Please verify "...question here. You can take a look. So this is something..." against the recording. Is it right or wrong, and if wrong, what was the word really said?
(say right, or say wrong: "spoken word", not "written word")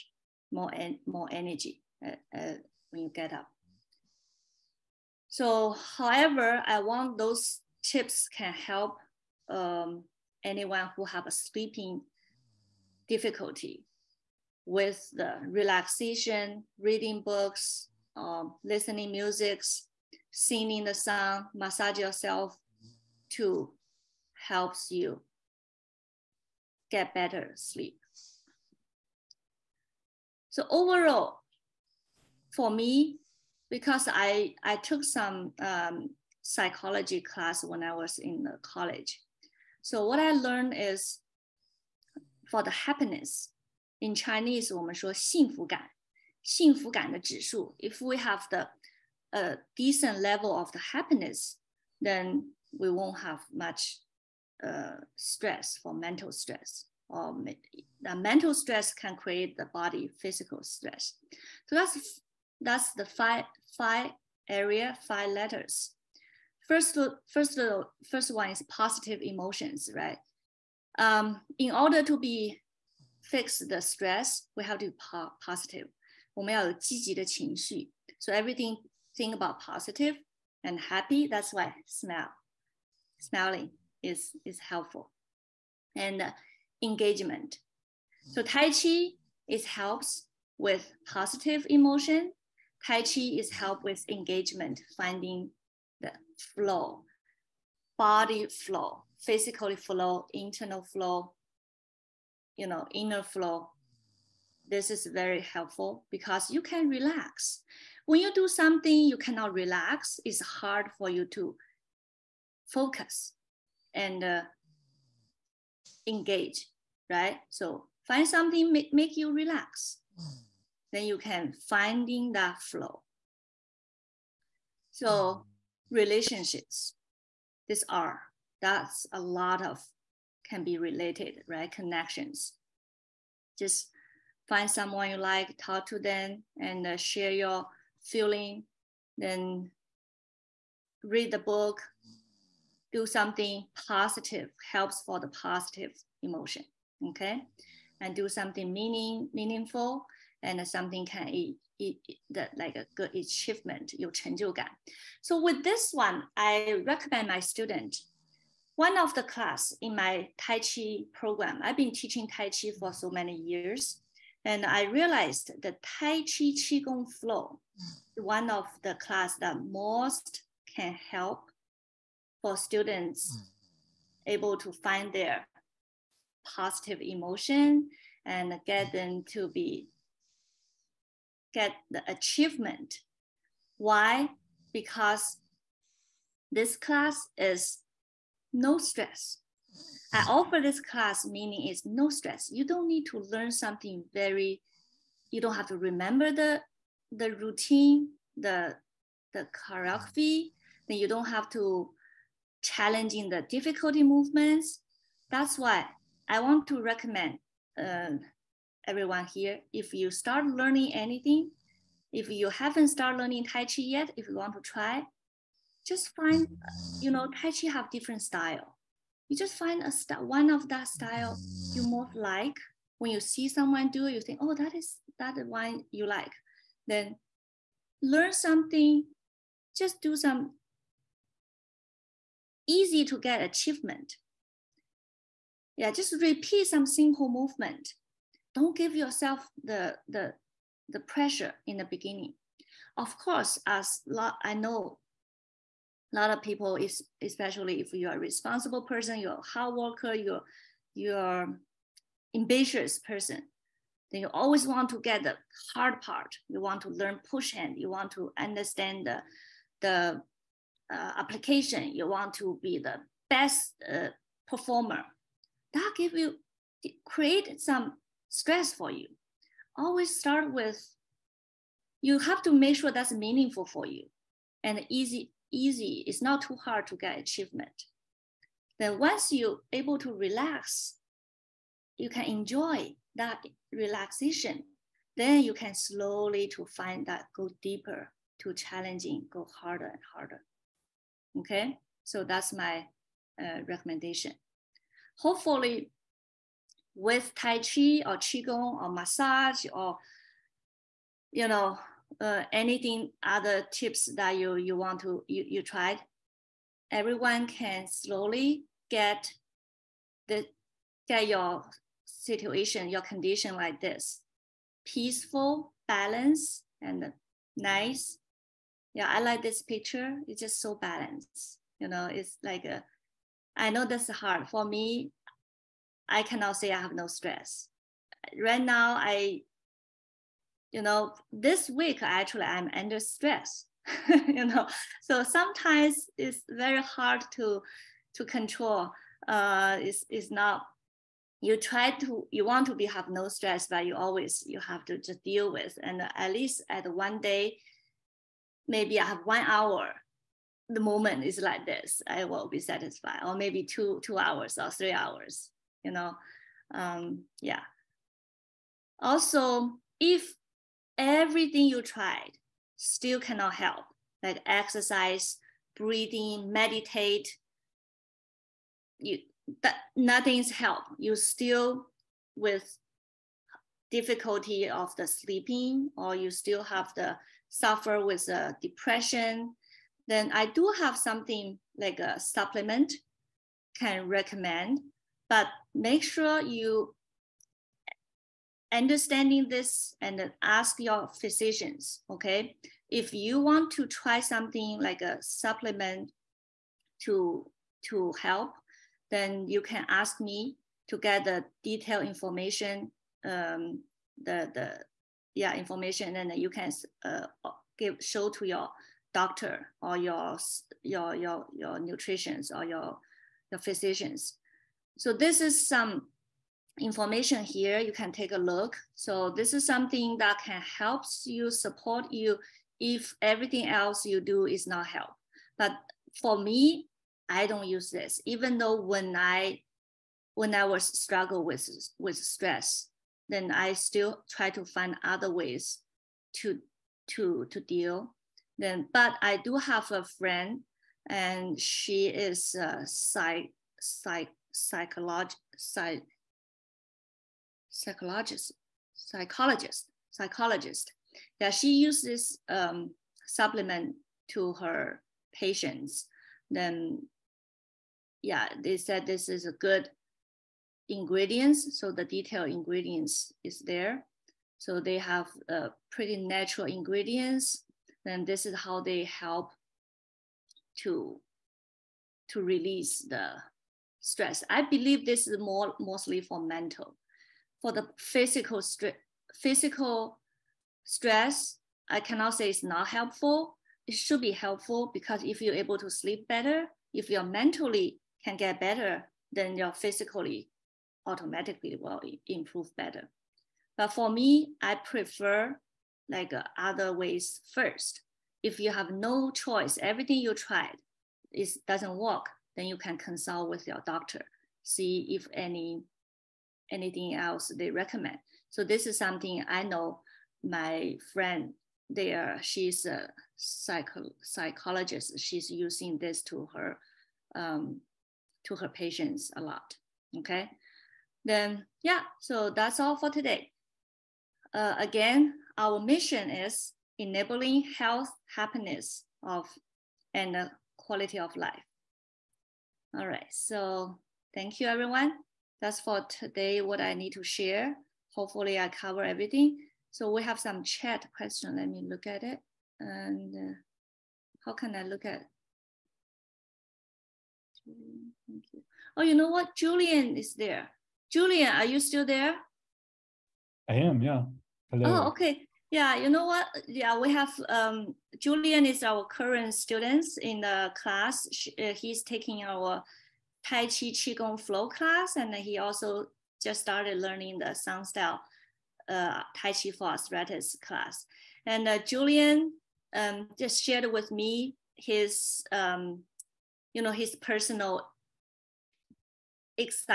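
wrong: "information", not "question".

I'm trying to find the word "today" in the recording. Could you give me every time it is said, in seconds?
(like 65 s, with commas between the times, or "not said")
523 s, 536 s.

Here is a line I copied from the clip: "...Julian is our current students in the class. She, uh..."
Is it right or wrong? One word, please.
right.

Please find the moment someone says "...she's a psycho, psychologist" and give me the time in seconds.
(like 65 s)
512 s.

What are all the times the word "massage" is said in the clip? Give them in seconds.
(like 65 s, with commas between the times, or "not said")
21 s, 298 s.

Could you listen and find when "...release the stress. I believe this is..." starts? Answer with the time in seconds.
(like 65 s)
472 s.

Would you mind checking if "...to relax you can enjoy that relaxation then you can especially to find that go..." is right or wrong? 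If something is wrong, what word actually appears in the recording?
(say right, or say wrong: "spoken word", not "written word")
wrong: "slowly", not "especially".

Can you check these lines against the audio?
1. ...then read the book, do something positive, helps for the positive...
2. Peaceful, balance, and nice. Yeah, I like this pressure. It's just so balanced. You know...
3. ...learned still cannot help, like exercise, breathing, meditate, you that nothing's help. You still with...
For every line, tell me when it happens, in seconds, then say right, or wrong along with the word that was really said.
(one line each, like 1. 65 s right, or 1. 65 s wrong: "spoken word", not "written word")
1. 139 s right
2. 314 s wrong: "picture", not "pressure"
3. 361 s wrong: "tried", not "learned".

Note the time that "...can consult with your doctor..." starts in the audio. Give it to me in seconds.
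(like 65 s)
502 s.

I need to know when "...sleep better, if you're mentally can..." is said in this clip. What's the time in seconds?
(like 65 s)
485 s.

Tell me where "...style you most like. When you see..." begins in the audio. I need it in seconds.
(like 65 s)
220 s.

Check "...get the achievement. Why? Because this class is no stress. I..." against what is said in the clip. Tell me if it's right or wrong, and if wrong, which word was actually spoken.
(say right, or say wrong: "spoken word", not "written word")
right.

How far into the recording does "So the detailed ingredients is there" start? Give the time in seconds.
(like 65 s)
461 s.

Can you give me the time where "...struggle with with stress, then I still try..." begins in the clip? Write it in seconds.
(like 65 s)
430 s.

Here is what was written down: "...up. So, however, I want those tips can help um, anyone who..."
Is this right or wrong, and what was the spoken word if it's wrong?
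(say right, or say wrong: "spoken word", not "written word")
right.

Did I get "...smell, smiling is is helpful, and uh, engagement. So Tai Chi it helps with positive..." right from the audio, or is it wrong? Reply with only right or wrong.
right.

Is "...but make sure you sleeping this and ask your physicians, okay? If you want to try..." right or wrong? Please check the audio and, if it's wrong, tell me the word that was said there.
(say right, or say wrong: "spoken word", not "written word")
wrong: "understanding", not "sleeping".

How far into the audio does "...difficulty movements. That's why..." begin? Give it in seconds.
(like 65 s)
203 s.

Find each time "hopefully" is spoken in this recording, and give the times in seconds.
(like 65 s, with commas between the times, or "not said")
295 s, 538 s.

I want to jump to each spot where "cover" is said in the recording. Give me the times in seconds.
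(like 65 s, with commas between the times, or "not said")
538 s.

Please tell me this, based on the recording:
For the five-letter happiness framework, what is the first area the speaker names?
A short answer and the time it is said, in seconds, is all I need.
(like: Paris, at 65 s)
Positive emotions, at 68 s.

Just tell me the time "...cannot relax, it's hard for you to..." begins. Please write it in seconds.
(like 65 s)
109 s.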